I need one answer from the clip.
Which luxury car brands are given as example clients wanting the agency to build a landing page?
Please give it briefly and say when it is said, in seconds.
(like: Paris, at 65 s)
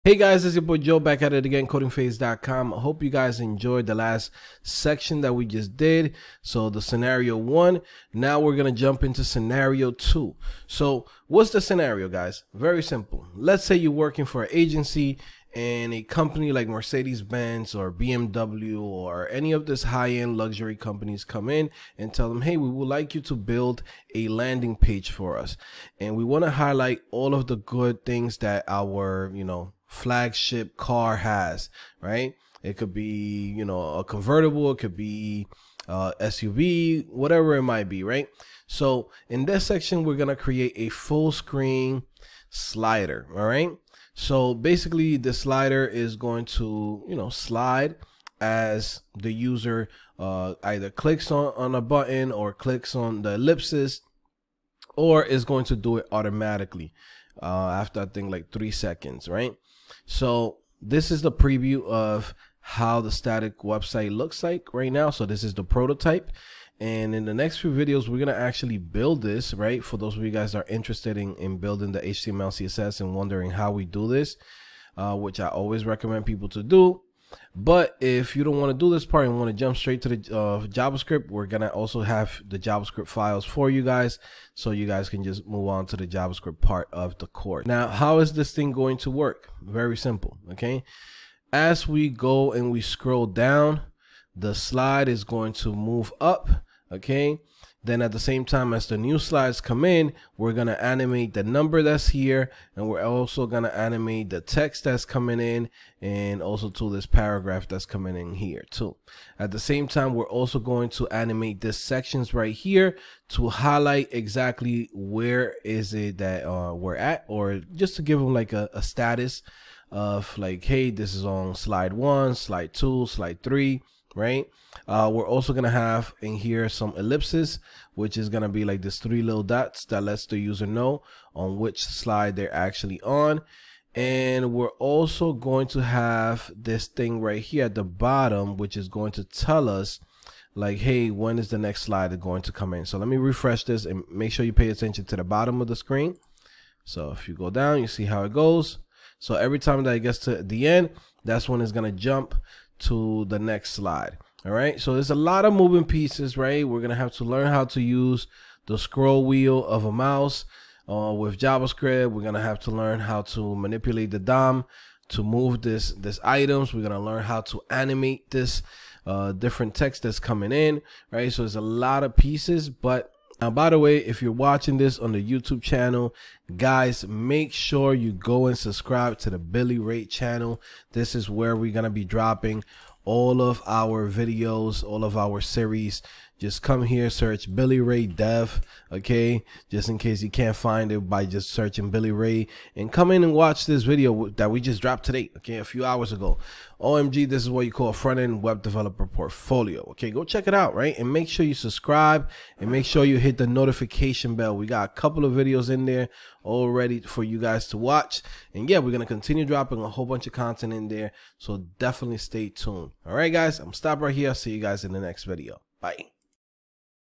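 Mercedes-Benz or BMW, at 16 s.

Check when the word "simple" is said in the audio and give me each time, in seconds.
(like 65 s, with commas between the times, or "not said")
12 s, 89 s.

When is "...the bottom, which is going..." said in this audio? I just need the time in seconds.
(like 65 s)
137 s.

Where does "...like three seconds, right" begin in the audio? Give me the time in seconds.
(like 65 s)
58 s.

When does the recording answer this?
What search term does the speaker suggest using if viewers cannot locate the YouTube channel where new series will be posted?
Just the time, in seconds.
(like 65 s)
187 s.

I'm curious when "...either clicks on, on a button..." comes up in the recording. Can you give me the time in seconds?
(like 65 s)
50 s.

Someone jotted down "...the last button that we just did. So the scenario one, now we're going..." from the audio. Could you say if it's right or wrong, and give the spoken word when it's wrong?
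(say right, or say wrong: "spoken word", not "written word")
wrong: "section", not "button".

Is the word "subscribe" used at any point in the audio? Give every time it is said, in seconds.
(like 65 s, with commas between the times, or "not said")
178 s, 201 s.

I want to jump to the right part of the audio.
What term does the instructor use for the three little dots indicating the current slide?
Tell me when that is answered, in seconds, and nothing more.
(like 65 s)
126 s.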